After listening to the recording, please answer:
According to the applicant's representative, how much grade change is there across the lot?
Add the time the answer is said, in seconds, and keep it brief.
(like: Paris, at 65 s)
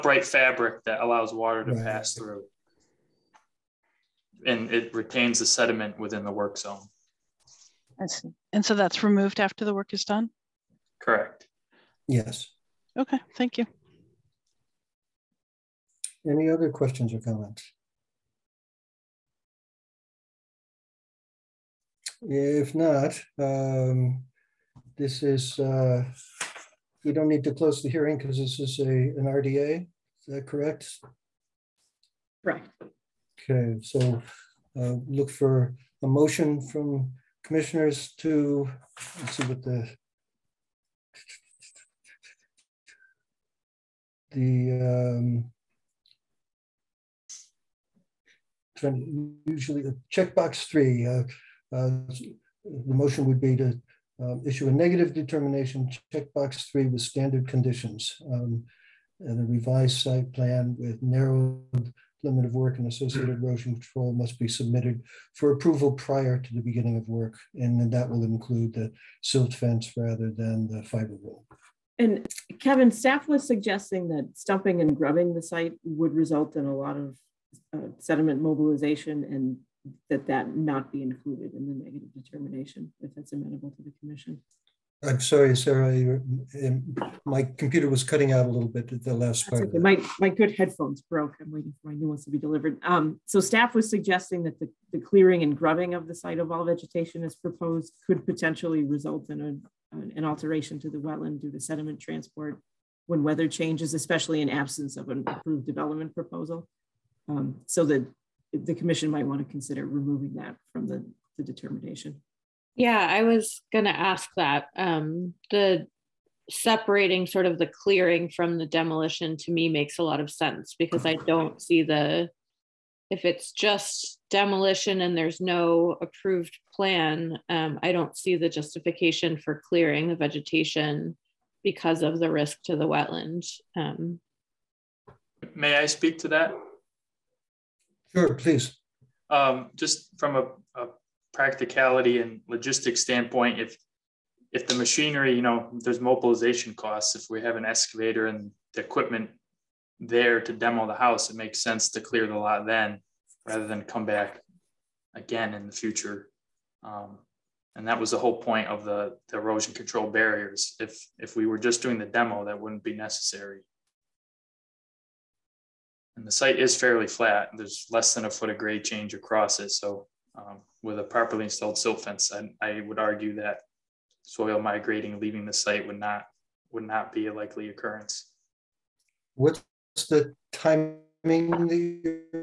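less than a foot, at 167 s.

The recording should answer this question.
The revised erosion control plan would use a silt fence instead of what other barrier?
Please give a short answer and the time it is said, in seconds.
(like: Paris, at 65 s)
fiber roll, at 70 s.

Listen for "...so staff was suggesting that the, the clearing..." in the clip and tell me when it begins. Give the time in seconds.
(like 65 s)
93 s.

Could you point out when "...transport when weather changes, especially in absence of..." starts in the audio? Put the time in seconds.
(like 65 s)
102 s.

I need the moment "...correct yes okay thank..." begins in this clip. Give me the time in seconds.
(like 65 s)
11 s.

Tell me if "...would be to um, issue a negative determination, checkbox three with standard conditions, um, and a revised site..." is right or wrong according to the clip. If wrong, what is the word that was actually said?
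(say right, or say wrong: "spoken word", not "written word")
right.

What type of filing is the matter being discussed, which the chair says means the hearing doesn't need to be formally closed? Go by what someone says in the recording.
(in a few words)
RDA.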